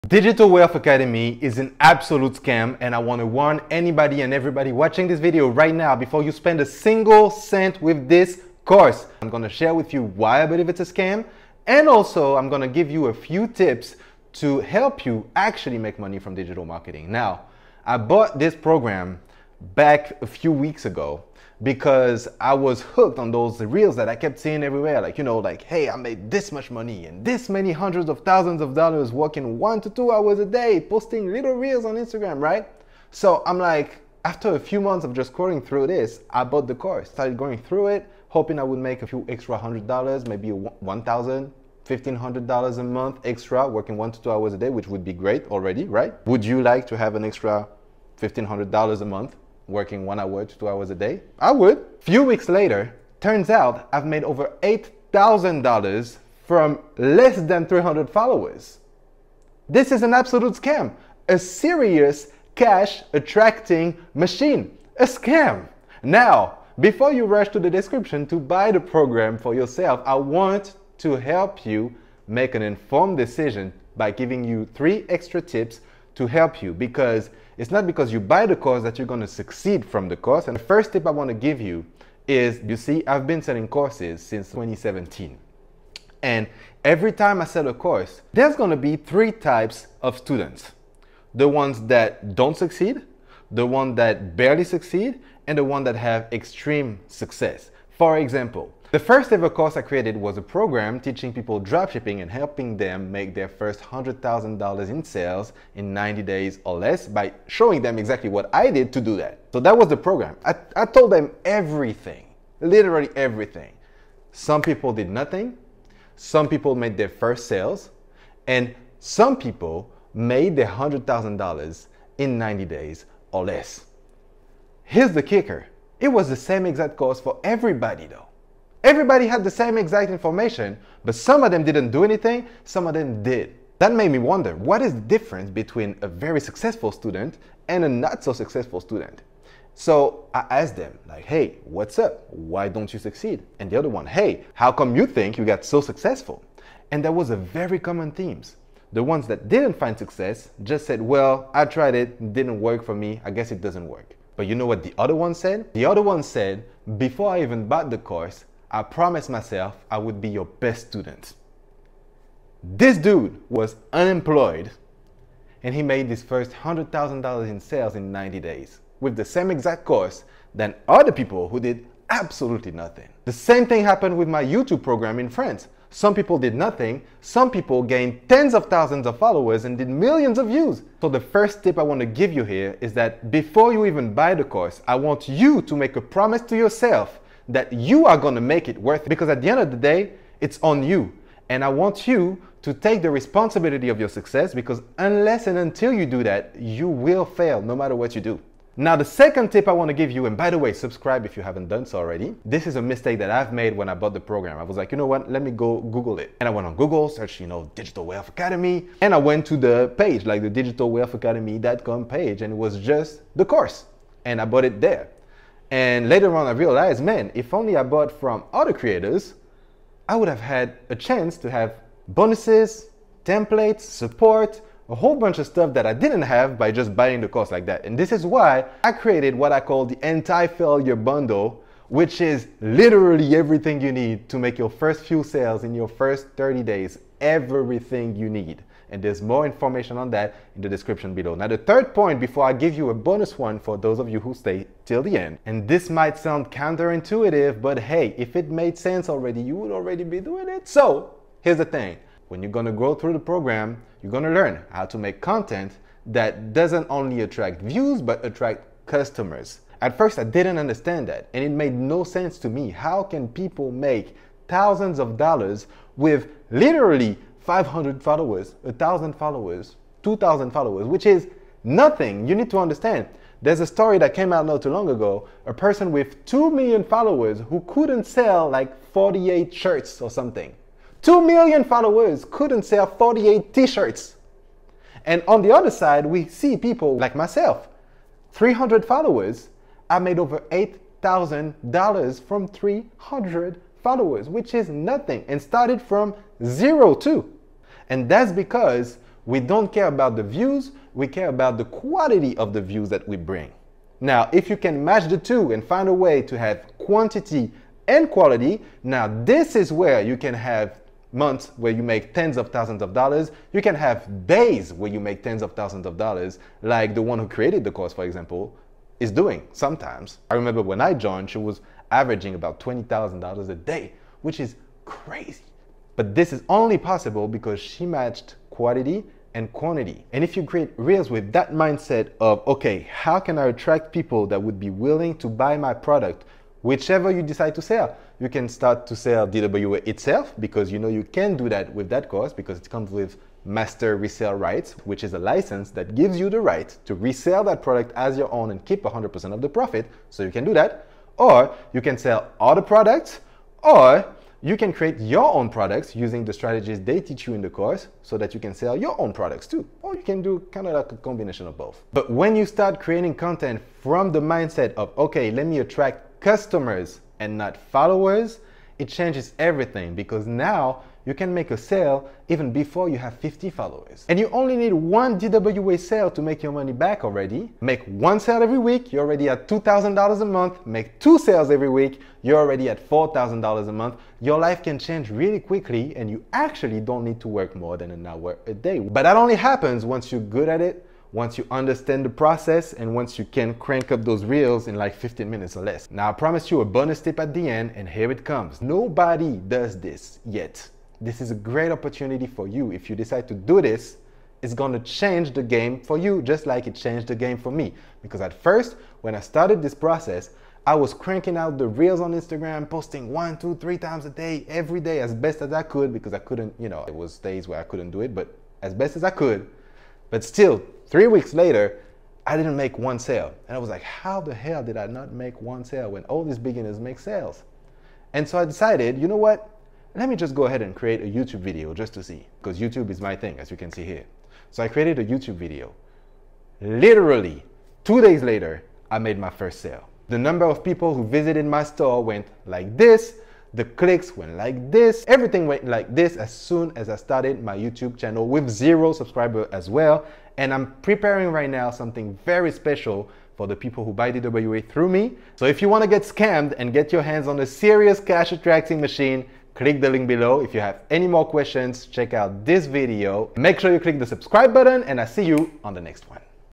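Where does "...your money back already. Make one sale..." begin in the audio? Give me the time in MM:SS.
06:16.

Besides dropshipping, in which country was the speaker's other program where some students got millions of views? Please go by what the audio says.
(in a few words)
France.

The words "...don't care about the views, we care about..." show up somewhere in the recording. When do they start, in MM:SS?
04:59.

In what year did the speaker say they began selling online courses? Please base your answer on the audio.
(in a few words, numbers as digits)
2017.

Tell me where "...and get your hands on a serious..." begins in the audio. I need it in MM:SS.
07:36.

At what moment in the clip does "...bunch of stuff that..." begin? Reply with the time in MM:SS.
03:45.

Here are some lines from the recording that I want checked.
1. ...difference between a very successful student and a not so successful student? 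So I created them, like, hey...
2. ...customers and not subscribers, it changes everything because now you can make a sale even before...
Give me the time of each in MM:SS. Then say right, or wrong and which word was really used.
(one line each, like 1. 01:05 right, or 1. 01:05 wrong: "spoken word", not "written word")
1. 02:15 wrong: "asked", not "created"
2. 06:06 wrong: "followers", not "subscribers".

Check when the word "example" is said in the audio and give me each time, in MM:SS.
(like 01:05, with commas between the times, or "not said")
01:38, 05:18.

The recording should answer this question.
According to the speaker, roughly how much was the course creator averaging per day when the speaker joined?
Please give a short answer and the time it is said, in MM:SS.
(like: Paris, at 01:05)
$20,000, at 05:22.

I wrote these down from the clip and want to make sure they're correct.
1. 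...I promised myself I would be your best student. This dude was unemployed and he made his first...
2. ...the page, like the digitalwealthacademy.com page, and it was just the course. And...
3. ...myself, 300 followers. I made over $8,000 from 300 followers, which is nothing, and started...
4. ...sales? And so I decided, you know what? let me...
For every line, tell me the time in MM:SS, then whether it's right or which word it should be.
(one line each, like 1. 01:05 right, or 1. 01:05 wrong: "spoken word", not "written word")
1. 02:38 right
2. 03:29 right
3. 04:47 right
4. 07:06 right.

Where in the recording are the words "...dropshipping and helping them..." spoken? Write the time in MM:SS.
01:41.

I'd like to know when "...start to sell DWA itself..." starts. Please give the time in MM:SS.
05:38.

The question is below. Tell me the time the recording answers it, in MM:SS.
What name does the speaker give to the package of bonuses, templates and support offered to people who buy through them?
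03:50.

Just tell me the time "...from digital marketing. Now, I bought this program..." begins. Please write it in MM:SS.
00:16.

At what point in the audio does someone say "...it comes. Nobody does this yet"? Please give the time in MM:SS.
06:38.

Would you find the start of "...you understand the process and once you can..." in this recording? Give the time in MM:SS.
06:31.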